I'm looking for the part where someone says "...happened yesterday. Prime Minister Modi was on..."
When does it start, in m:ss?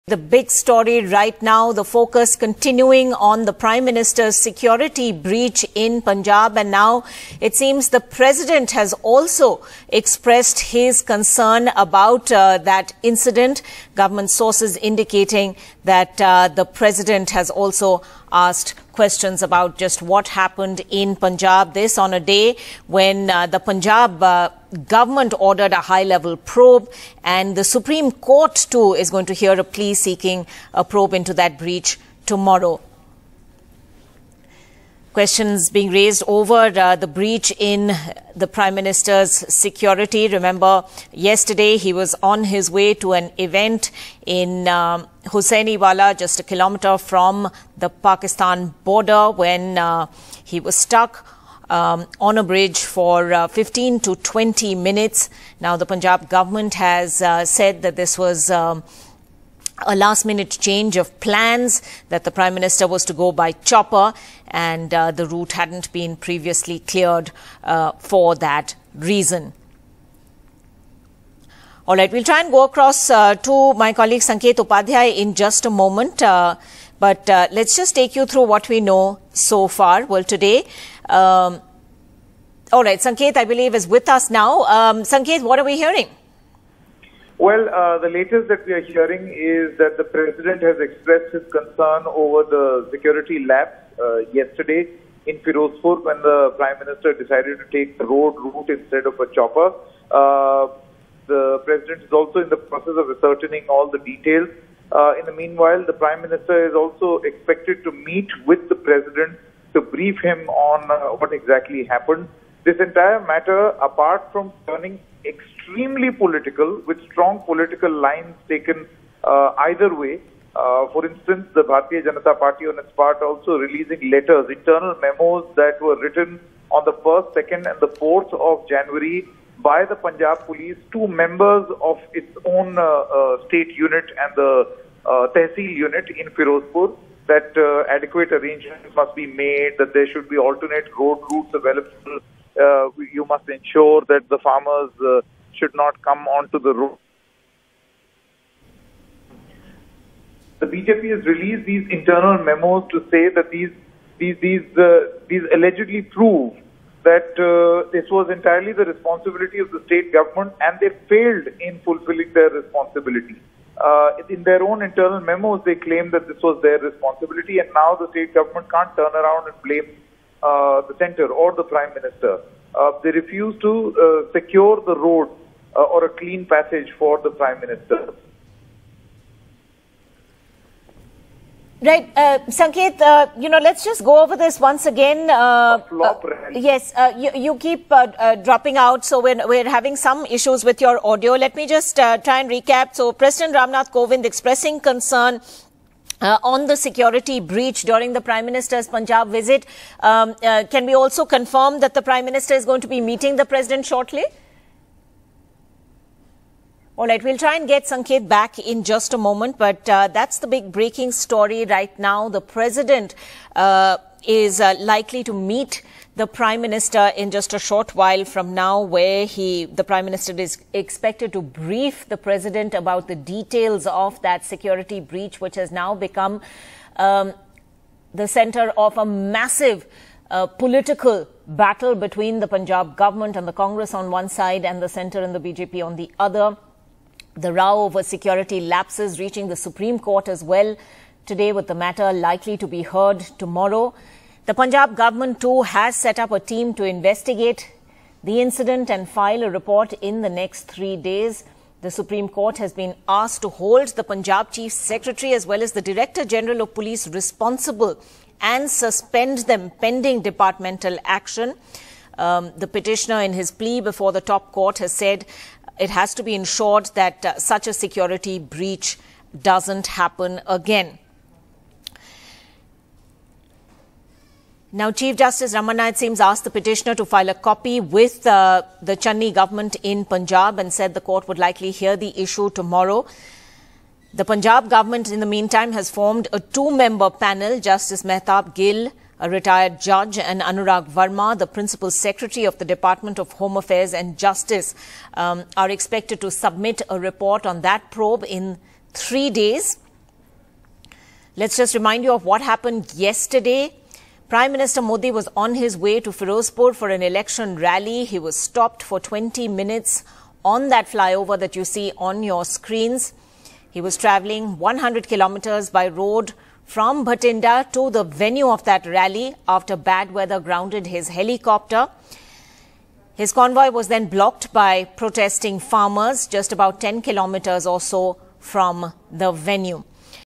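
5:02.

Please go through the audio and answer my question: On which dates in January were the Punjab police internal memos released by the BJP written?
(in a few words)
1st, 2nd and 4th.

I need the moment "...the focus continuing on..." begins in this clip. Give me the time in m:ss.
0:01.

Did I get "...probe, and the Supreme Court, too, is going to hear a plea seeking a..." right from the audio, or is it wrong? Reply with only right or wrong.
right.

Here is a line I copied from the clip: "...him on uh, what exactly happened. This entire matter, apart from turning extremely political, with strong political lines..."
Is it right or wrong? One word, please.
right.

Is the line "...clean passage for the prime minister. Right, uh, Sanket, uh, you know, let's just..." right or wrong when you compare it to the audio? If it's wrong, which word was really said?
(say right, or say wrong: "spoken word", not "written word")
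right.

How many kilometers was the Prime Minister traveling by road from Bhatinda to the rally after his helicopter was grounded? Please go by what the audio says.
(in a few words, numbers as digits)
100.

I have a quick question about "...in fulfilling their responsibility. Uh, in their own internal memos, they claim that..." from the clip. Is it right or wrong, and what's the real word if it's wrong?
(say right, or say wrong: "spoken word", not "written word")
right.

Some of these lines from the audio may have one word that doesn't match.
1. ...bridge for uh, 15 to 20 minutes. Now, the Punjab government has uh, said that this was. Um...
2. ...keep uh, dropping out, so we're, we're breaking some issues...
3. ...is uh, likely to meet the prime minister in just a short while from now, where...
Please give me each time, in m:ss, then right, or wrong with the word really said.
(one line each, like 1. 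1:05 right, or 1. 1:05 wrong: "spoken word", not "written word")
1. 0:52 right
2. 3:07 wrong: "having", not "breaking"
3. 3:34 right.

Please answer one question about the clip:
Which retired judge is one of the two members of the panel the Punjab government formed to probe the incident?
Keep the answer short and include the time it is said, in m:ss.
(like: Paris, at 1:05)
Mehtab Gill, at 4:48.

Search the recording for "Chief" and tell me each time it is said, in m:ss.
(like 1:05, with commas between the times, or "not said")
4:14, 4:34.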